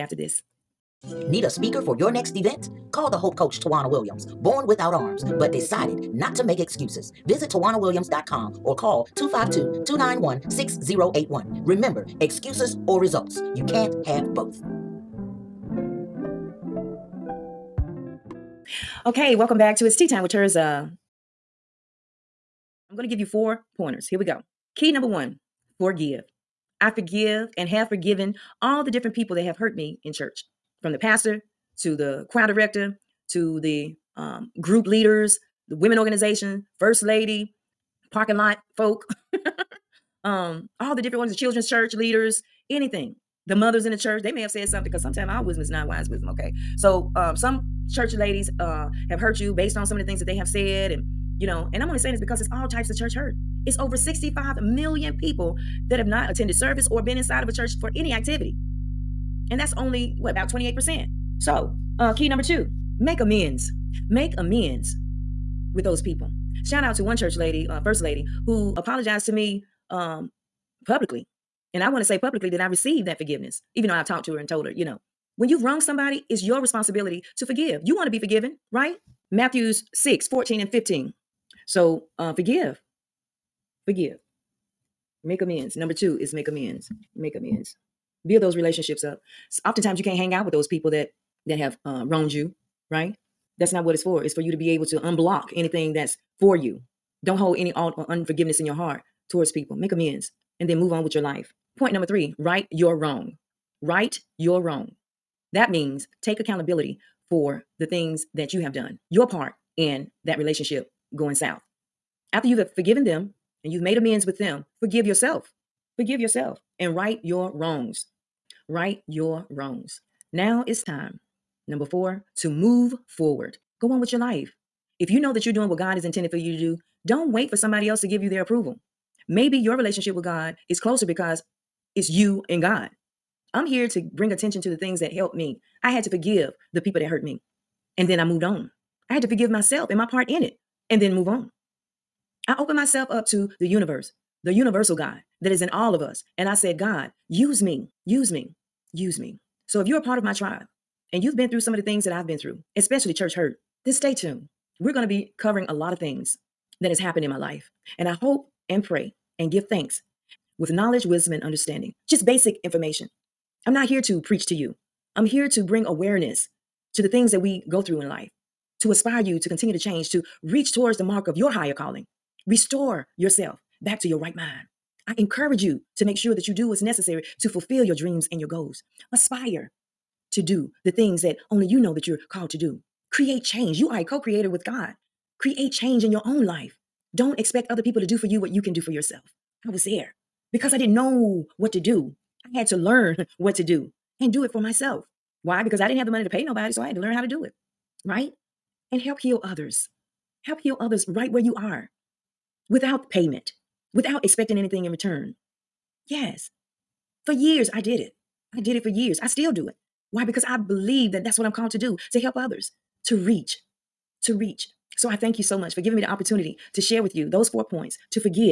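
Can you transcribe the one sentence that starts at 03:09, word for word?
I was there because I didn't know what to do.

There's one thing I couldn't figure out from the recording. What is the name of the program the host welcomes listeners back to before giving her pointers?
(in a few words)
It's Tea Time with Tirzah.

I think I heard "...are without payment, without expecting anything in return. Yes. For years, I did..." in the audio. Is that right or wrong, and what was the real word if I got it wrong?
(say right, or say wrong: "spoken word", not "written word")
right.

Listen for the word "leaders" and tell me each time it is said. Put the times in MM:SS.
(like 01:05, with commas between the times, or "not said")
00:34, 00:41.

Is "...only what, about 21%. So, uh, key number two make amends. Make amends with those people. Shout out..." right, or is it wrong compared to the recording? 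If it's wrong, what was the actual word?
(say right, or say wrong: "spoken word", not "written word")
wrong: "28", not "21".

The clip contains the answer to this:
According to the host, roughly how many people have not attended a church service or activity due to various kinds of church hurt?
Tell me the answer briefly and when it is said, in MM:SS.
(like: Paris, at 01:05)
65 million, at 00:53.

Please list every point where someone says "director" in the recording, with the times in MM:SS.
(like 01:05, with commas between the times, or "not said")
00:32.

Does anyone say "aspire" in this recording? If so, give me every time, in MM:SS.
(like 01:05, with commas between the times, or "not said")
02:48, 02:59.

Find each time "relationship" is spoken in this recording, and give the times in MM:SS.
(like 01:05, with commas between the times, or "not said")
01:28, 01:50, 02:09.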